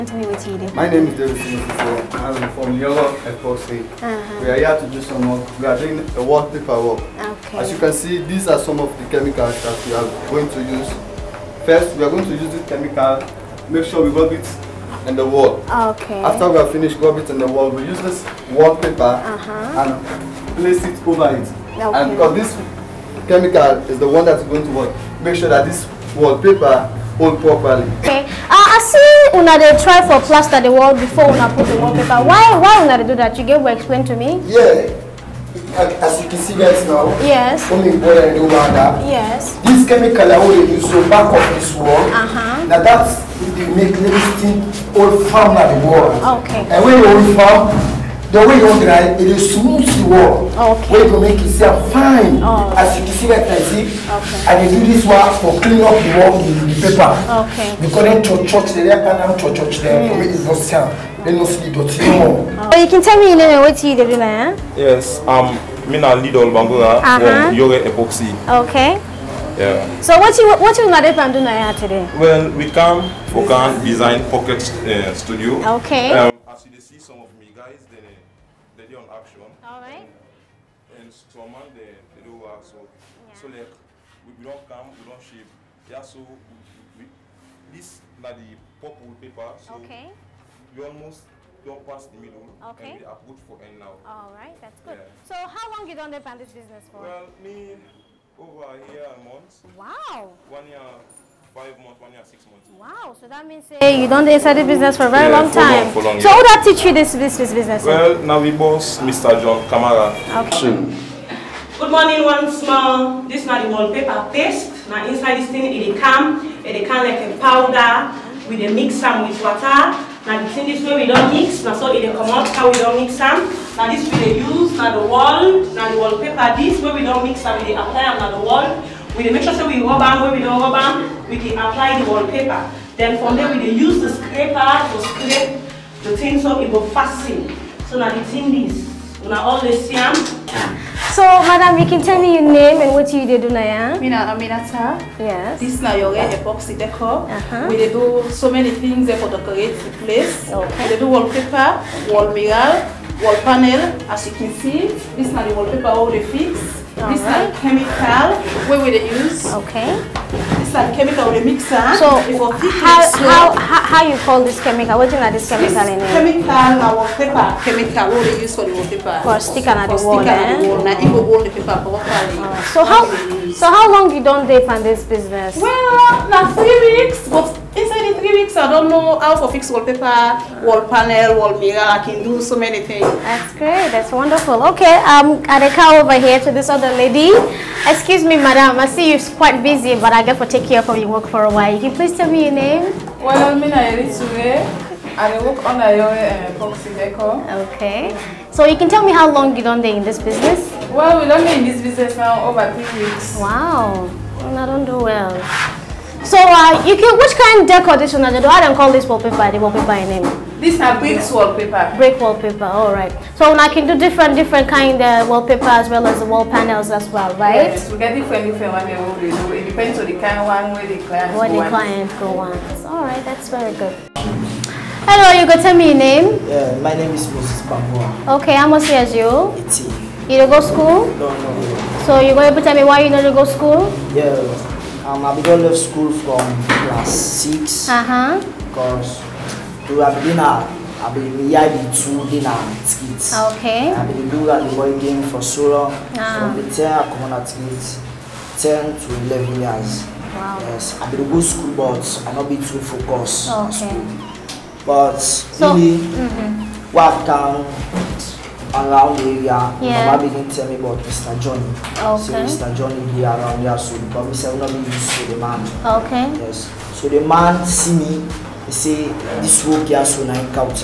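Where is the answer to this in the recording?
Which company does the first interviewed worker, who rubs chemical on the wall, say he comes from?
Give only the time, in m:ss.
0:02.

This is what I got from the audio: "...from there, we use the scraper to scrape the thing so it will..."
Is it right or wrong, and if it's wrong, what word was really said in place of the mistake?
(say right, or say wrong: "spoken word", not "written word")
right.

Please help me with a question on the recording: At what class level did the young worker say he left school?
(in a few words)
Class 6.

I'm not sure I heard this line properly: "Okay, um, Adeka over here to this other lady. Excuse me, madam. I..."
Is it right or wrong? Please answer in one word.
right.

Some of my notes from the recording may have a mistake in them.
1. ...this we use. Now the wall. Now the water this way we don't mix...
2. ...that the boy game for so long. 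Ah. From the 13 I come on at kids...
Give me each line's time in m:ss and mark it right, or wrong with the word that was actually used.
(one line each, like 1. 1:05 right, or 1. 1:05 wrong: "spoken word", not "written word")
1. 2:03 wrong: "wallpaper", not "water"
2. 4:04 wrong: "10", not "13".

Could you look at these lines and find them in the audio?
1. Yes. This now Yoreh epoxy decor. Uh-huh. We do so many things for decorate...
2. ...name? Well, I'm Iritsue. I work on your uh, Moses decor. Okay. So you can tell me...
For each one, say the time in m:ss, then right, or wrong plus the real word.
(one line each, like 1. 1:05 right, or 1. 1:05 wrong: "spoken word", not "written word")
1. 2:25 right
2. 3:12 wrong: "Epoxy", not "Moses".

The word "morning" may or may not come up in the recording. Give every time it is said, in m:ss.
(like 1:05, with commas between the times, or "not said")
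1:51.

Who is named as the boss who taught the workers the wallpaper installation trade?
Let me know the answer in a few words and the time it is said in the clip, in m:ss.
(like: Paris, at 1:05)
Mr. John Kamara, at 1:48.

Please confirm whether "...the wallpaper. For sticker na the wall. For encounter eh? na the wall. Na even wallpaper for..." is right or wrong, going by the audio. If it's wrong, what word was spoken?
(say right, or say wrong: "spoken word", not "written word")
wrong: "sticker", not "encounter".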